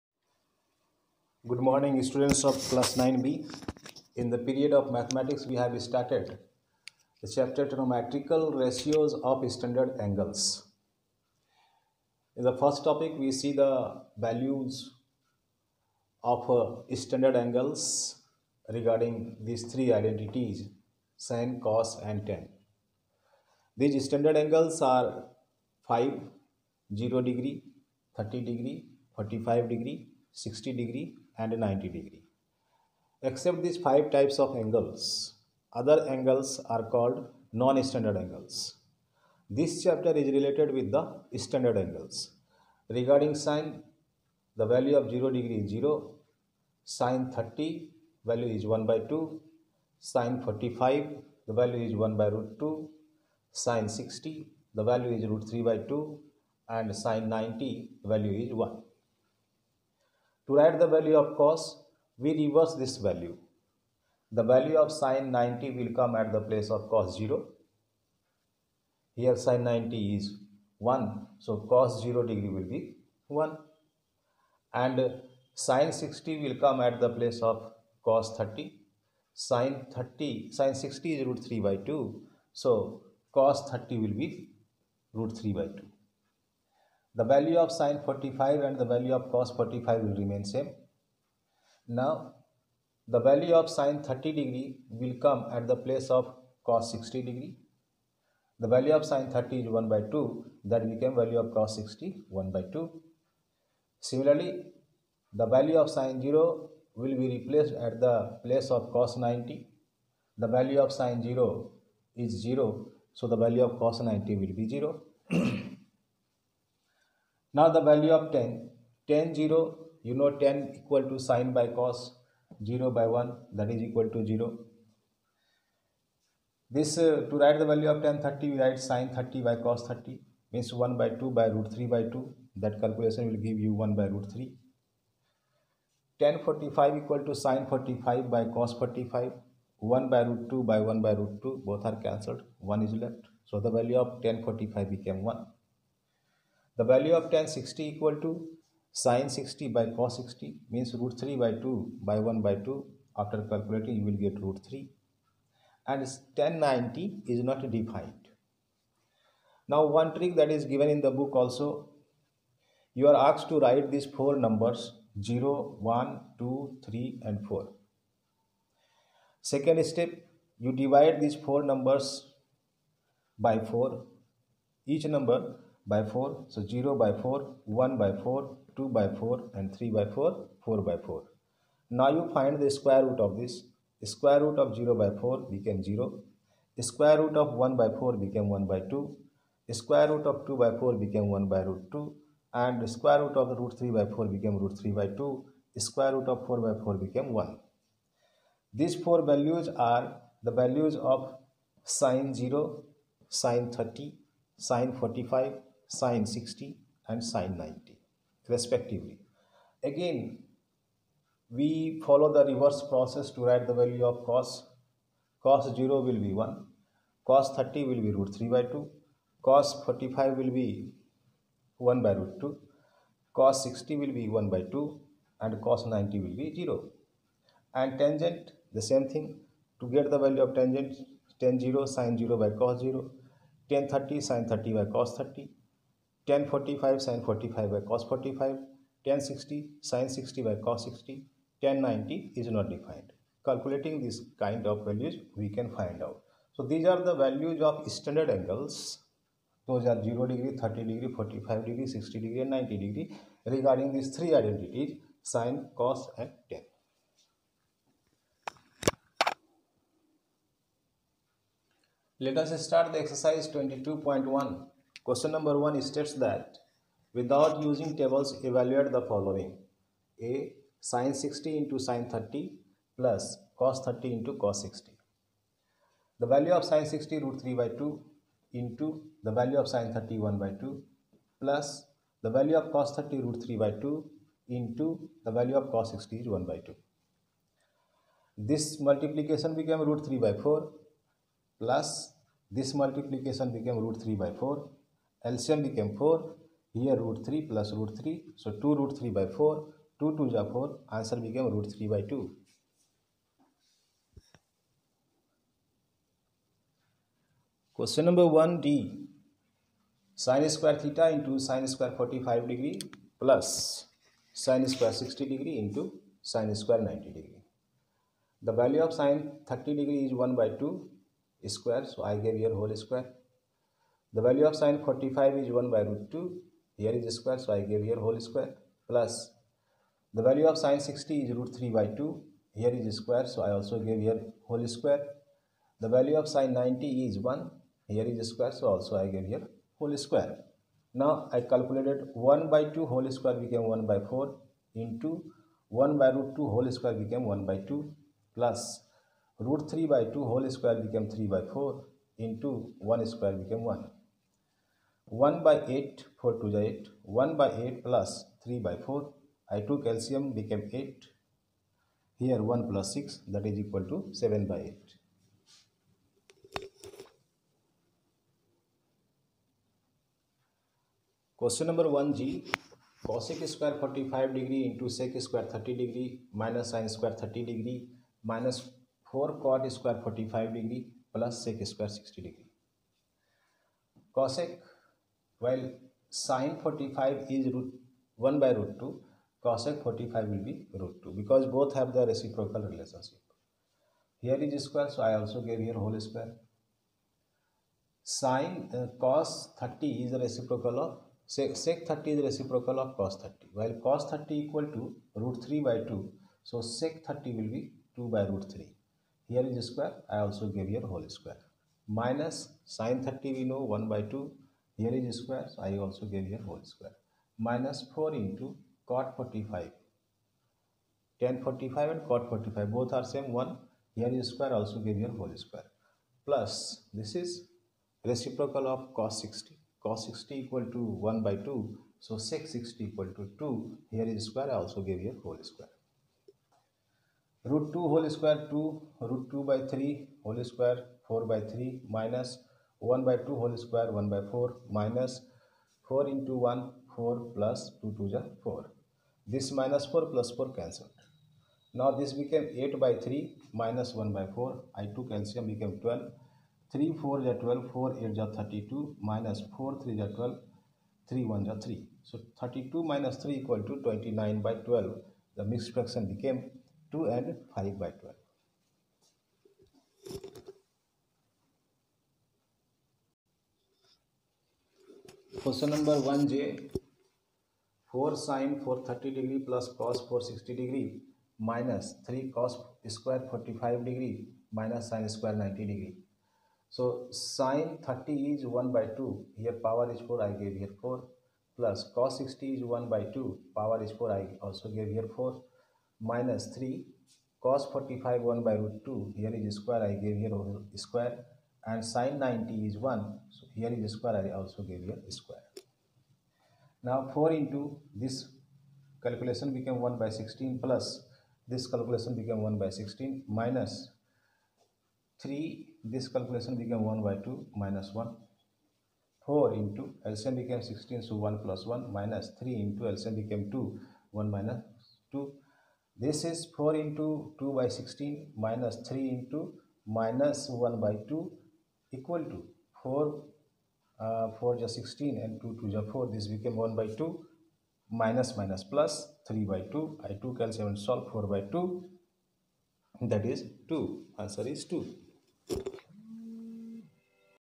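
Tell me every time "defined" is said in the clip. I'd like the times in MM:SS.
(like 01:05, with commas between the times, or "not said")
02:37, 04:02.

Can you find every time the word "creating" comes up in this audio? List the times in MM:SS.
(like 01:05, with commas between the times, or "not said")
not said.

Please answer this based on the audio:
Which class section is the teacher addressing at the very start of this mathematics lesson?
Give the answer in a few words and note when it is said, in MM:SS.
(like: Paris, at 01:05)
9b, at 00:02.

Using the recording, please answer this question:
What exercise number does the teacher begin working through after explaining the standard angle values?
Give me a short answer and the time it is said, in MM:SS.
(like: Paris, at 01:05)
22.1, at 04:23.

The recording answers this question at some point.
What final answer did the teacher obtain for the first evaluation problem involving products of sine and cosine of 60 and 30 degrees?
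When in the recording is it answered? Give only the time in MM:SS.
05:01.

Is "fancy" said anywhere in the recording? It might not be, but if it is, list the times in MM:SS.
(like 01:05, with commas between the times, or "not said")
not said.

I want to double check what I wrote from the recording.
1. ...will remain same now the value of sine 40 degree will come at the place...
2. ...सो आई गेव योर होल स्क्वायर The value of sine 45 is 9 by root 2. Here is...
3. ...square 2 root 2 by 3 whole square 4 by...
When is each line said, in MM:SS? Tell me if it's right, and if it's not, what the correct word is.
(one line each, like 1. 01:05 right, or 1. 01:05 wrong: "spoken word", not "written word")
1. 01:30 wrong: "30", not "40"
2. 05:21 wrong: "1", not "9"
3. 07:18 right.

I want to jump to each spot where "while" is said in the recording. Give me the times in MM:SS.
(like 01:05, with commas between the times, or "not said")
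06:25, 06:43.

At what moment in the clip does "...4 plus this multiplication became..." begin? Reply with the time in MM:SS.
04:50.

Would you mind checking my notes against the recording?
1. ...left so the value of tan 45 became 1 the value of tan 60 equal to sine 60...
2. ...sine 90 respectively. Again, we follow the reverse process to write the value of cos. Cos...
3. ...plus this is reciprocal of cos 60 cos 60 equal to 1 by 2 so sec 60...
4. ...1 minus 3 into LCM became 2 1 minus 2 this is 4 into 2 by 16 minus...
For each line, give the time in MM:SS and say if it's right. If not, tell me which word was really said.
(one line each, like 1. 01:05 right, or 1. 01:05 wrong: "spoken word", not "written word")
1. 02:23 right
2. 03:27 right
3. 07:06 right
4. 08:41 right.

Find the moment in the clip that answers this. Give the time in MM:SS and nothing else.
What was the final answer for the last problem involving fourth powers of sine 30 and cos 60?
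09:04.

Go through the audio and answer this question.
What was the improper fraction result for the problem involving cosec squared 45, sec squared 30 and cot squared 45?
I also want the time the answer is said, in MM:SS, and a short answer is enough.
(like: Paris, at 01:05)
29/12, at 07:43.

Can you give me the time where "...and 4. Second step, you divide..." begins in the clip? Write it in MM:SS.
02:47.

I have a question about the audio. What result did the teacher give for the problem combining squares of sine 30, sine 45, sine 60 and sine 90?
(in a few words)
7/8.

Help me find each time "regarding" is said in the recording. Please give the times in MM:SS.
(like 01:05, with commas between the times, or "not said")
00:18, 00:42, 04:13.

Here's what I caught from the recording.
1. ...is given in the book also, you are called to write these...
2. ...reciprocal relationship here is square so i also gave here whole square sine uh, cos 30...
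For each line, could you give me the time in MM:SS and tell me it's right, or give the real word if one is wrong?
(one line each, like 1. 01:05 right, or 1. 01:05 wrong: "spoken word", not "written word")
1. 02:40 wrong: "asked", not "called"
2. 06:32 right.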